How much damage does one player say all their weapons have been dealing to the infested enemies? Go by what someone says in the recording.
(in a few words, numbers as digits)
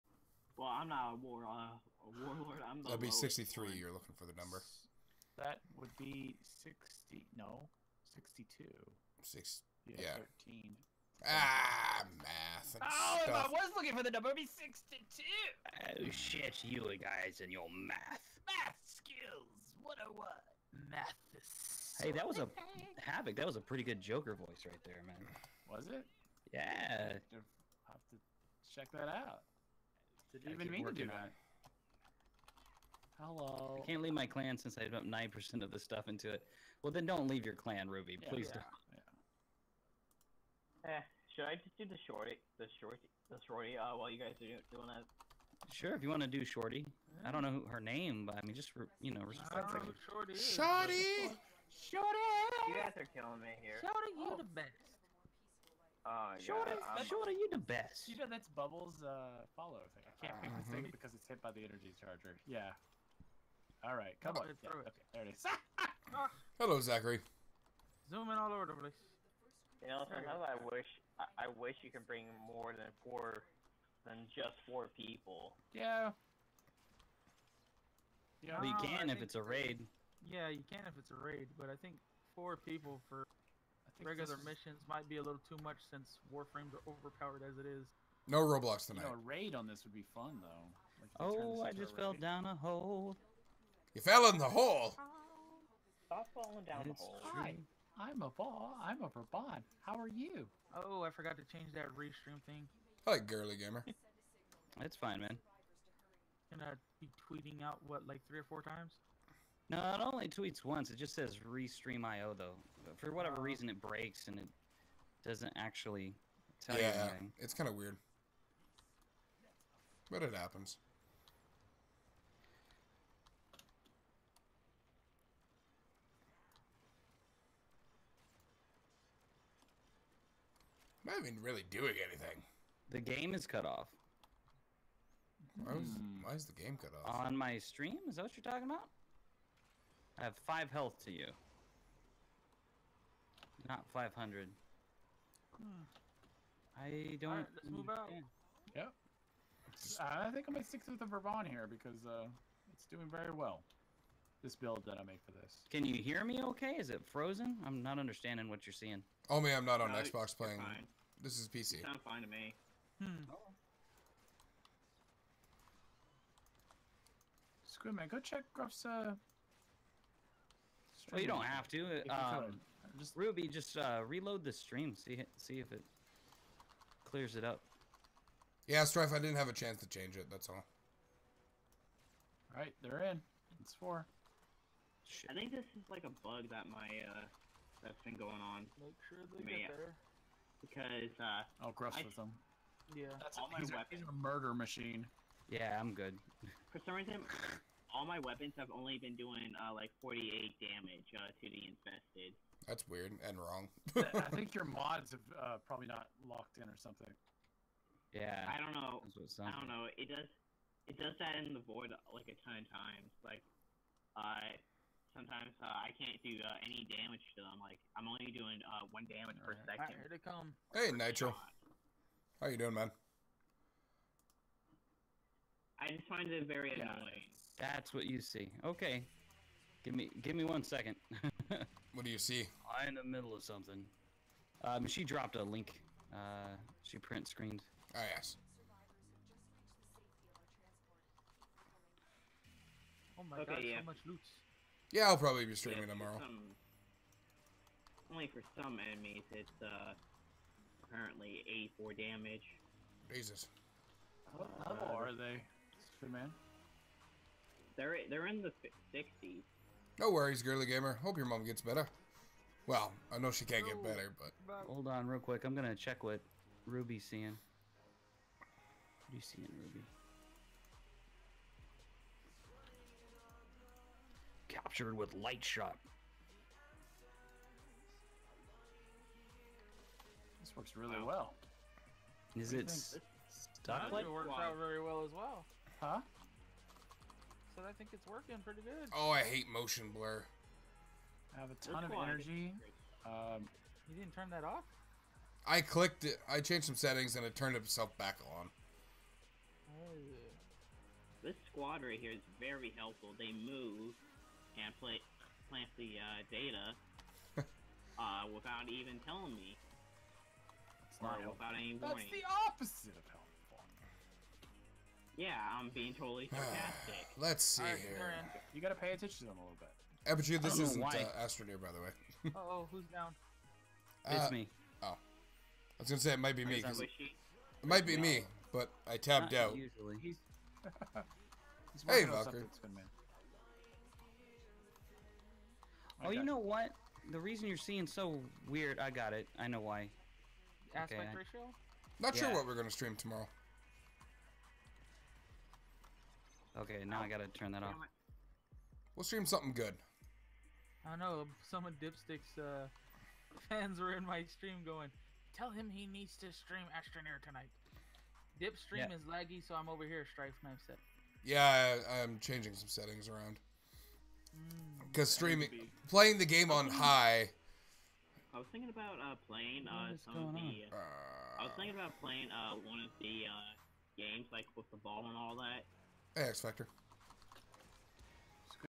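48.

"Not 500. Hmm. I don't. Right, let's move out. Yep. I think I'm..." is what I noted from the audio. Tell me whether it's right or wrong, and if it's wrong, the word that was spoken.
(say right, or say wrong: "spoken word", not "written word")
right.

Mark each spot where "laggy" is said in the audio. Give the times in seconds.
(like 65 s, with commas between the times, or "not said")
359 s.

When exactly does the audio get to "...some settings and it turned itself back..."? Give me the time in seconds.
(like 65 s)
296 s.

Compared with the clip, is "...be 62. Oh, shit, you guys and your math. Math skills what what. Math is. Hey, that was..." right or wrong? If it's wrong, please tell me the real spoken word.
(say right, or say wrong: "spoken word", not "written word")
right.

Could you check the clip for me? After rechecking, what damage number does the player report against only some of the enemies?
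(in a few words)
84.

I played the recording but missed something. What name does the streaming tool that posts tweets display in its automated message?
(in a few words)
restream IO.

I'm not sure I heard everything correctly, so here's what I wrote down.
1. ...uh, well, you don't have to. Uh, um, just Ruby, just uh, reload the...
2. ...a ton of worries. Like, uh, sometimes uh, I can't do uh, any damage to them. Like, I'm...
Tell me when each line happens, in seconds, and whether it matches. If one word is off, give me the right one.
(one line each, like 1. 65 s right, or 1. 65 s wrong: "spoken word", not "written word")
1. 168 s right
2. 212 s wrong: "times", not "worries".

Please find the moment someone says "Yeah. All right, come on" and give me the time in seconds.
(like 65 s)
62 s.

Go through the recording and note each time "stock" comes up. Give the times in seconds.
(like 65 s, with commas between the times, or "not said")
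not said.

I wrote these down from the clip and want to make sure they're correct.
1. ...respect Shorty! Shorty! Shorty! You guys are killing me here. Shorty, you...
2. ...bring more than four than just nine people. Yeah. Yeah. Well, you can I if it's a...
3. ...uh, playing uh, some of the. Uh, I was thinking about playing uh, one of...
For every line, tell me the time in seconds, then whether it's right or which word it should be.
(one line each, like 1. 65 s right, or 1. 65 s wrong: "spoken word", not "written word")
1. 49 s right
2. 72 s wrong: "four", not "nine"
3. 368 s right.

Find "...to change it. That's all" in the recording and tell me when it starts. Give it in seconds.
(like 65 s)
179 s.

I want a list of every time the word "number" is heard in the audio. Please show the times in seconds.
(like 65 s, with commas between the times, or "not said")
4 s, 14 s.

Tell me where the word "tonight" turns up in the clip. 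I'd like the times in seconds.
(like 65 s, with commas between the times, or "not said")
88 s, 357 s.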